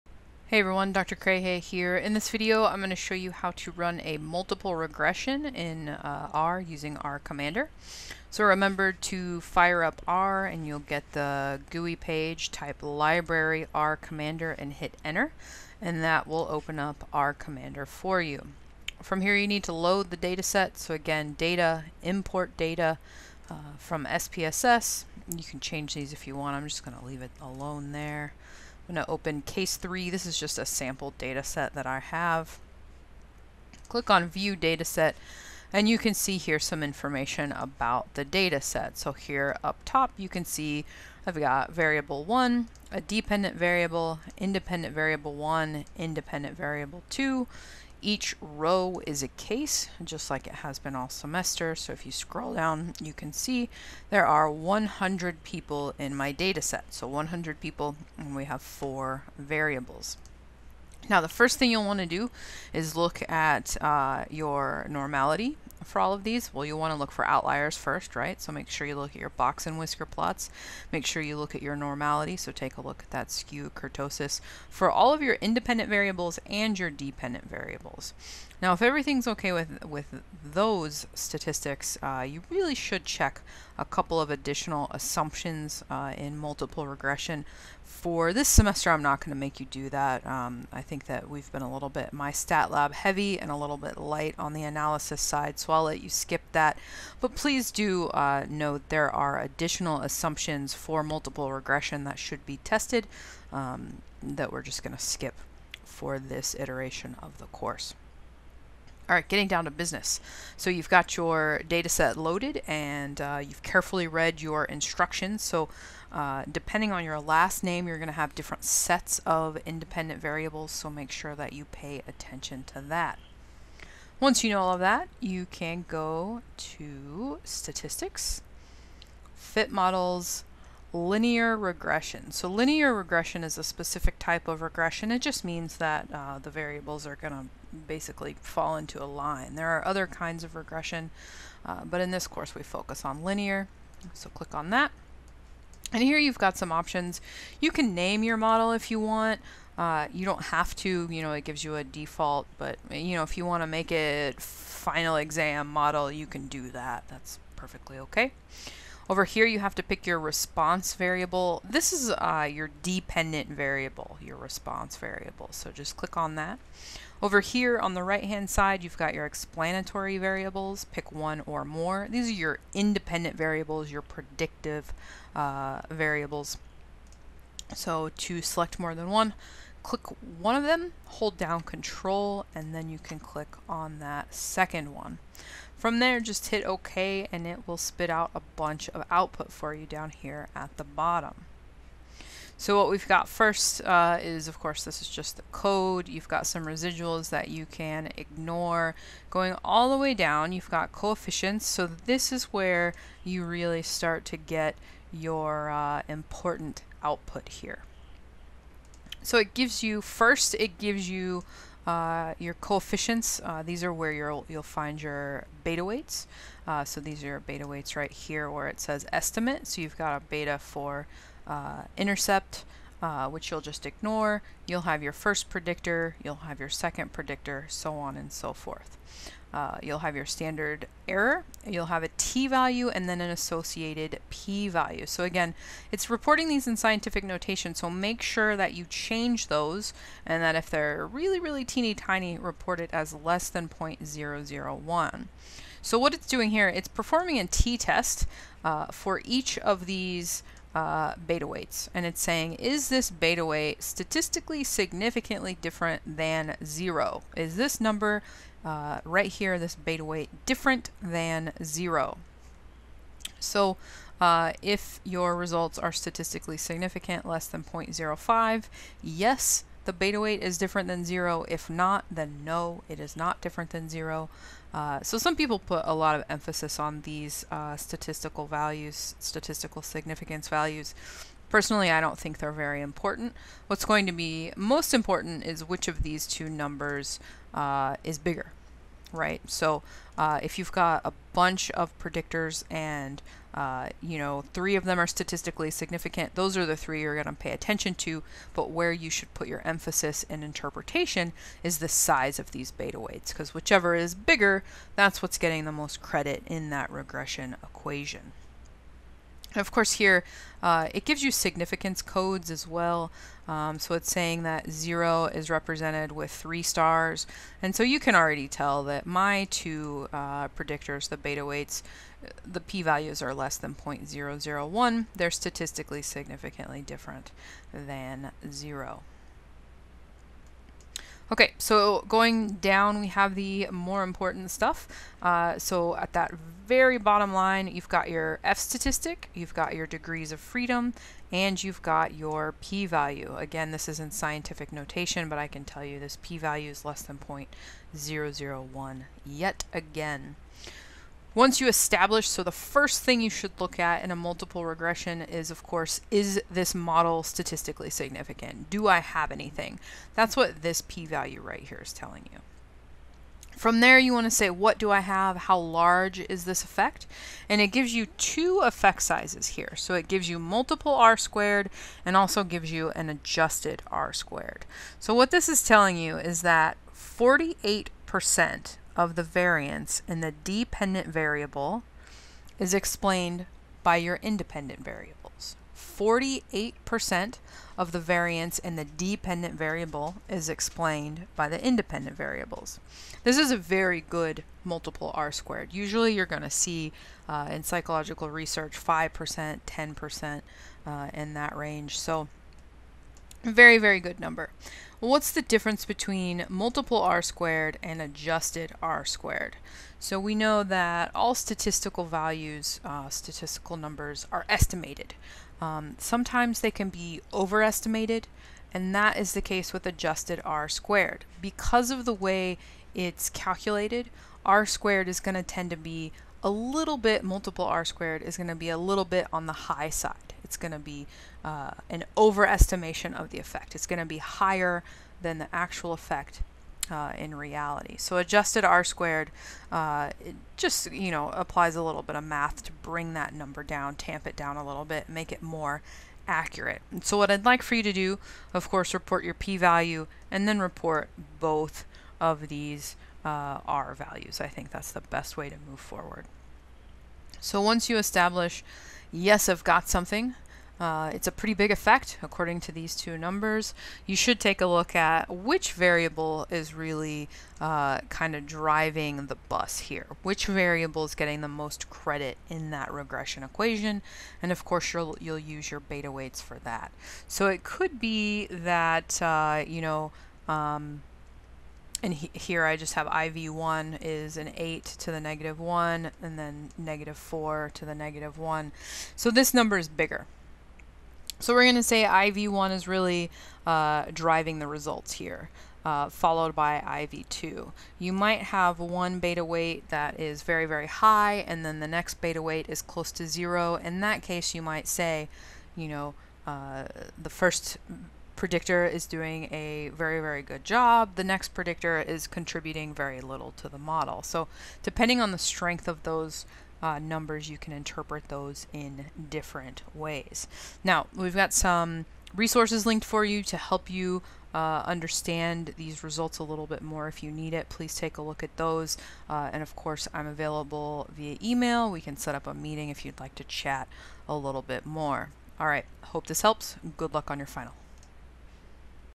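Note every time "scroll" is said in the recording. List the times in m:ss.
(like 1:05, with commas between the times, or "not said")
0:52.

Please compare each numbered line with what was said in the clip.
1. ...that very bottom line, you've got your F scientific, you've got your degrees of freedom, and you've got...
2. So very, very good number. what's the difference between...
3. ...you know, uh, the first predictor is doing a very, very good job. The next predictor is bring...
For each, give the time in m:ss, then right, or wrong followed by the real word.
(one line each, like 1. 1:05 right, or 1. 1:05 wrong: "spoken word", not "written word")
1. 5:36 wrong: "statistic", not "scientific"
2. 6:41 right
3. 8:25 wrong: "contributing", not "bring".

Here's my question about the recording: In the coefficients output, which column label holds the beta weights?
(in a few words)
estimate.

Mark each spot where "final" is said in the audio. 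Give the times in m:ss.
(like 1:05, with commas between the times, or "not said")
2:34, 8:57.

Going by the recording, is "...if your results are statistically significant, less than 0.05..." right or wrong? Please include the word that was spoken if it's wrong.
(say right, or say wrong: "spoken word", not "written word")
right.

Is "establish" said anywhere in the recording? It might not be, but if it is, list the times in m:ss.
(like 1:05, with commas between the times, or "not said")
5:51, 7:37.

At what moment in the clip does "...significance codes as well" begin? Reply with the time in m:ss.
5:11.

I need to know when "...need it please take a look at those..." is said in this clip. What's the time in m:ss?
8:47.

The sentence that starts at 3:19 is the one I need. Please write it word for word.
Going all the way down, you've got coefficients.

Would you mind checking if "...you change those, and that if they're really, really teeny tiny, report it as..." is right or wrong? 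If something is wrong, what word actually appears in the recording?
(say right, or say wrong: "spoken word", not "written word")
right.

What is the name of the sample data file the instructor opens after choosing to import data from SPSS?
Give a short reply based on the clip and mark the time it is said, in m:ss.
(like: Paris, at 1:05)
case 3, at 0:29.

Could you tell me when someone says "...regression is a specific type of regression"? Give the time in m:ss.
2:12.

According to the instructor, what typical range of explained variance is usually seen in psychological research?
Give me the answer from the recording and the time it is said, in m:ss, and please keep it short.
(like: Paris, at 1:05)
5% to 10%, at 6:38.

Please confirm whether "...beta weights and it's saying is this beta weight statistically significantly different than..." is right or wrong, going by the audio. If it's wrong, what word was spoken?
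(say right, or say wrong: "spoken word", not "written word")
right.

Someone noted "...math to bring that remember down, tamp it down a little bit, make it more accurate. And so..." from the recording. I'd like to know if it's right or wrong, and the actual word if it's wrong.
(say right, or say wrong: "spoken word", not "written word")
wrong: "number", not "remember".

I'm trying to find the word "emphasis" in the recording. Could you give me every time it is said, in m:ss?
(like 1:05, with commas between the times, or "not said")
4:36, 4:59.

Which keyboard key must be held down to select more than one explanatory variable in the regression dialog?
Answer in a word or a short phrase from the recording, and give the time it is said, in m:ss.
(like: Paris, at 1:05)
control, at 3:01.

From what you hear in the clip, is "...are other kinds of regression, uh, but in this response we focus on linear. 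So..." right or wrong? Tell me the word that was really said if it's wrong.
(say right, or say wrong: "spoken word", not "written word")
wrong: "course", not "response".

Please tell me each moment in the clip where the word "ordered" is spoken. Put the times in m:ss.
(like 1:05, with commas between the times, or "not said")
not said.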